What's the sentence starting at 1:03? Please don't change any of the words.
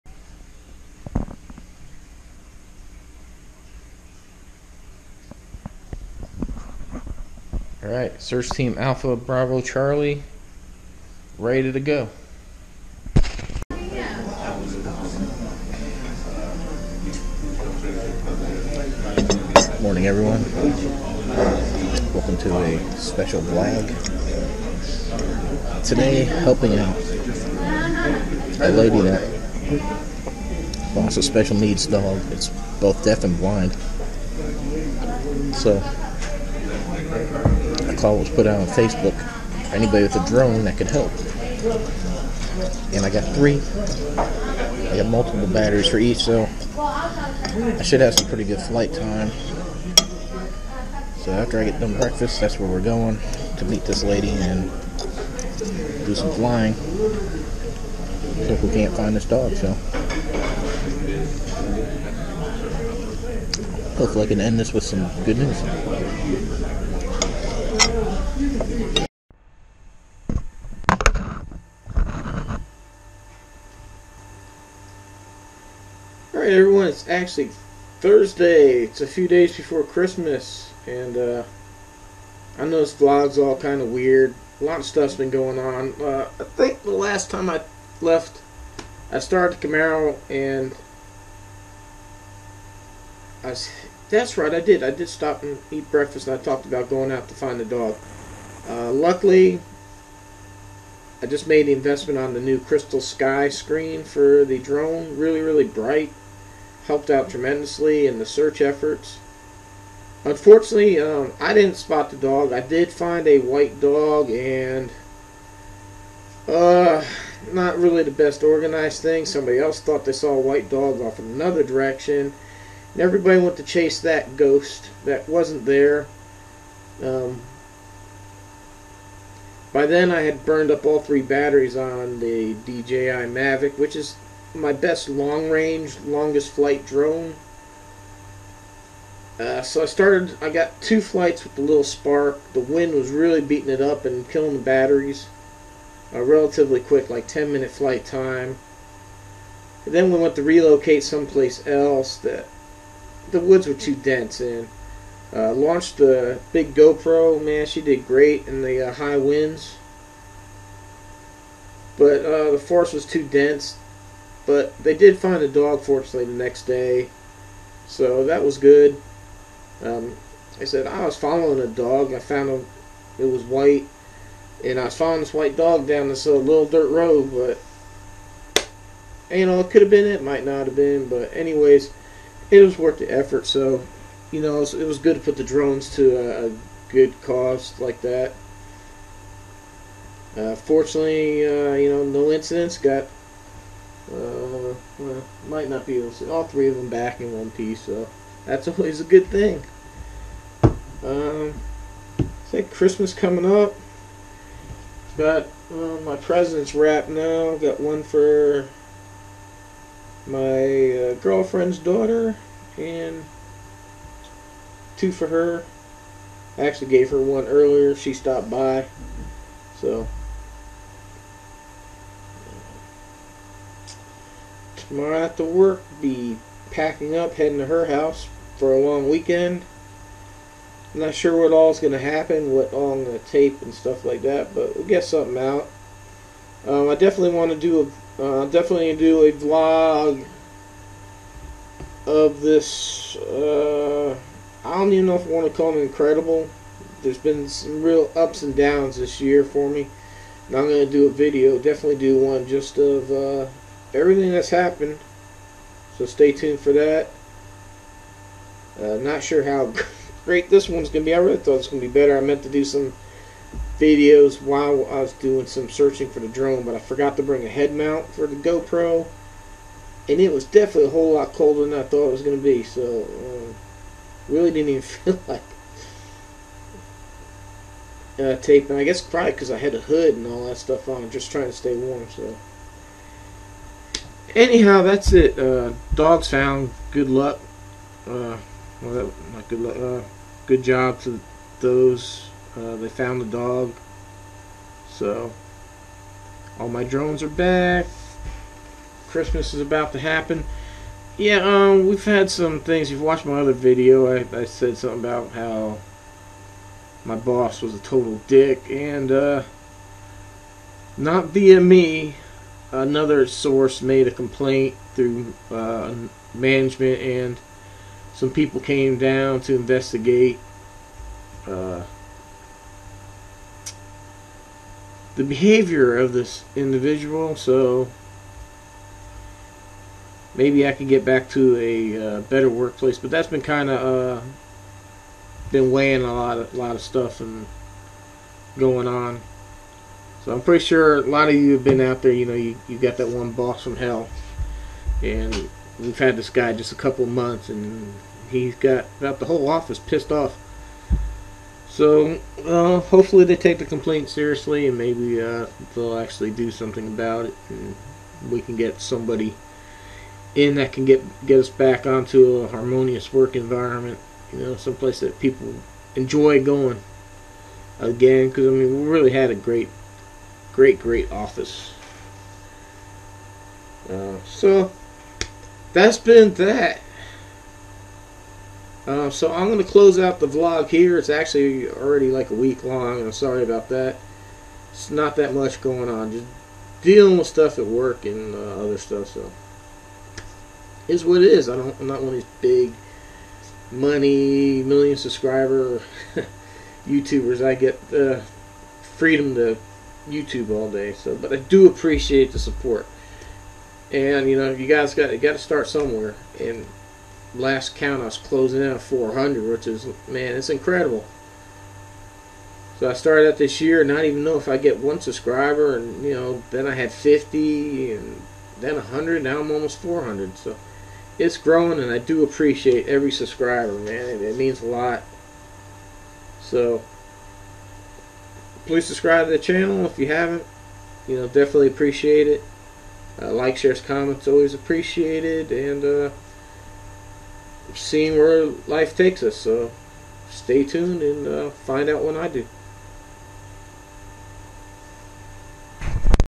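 Hopefully I can end this with some good news.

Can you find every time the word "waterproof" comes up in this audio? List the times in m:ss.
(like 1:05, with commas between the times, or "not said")
not said.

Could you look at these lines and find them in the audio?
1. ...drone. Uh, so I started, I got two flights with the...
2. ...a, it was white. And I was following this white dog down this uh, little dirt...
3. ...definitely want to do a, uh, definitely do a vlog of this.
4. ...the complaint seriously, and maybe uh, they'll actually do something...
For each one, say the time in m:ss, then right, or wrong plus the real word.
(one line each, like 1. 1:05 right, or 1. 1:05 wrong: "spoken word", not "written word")
1. 2:16 right
2. 2:52 right
3. 3:56 right
4. 5:53 right.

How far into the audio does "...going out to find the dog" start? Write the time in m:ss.
1:36.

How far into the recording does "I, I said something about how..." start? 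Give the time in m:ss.
5:04.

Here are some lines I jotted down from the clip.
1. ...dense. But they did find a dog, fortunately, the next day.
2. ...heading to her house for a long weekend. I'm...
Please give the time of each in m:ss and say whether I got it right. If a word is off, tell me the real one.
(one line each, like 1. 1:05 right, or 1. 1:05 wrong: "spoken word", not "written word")
1. 2:43 right
2. 3:47 right.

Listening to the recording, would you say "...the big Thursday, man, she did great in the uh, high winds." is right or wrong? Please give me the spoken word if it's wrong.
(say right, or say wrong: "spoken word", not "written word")
wrong: "GoPro", not "Thursday".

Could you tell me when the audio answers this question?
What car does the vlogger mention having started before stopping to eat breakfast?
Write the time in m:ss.
1:29.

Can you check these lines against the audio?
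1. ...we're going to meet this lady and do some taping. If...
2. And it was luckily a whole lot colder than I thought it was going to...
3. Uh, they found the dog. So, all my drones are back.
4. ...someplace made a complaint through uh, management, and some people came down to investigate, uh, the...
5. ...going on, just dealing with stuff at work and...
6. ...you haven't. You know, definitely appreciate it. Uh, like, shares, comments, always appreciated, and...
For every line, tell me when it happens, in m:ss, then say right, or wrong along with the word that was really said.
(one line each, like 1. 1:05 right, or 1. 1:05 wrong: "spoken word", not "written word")
1. 0:52 wrong: "flying", not "taping"
2. 4:30 wrong: "definitely", not "luckily"
3. 4:52 right
4. 5:13 wrong: "source", not "someplace"
5. 6:25 right
6. 7:09 right.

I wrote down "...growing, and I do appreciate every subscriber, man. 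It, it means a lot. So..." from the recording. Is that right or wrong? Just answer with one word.
right.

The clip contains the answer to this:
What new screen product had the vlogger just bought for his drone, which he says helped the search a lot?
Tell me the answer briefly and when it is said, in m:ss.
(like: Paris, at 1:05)
CrystalSky, at 1:42.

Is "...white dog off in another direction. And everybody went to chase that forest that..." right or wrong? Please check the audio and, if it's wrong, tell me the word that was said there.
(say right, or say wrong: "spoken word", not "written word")
wrong: "ghost", not "forest".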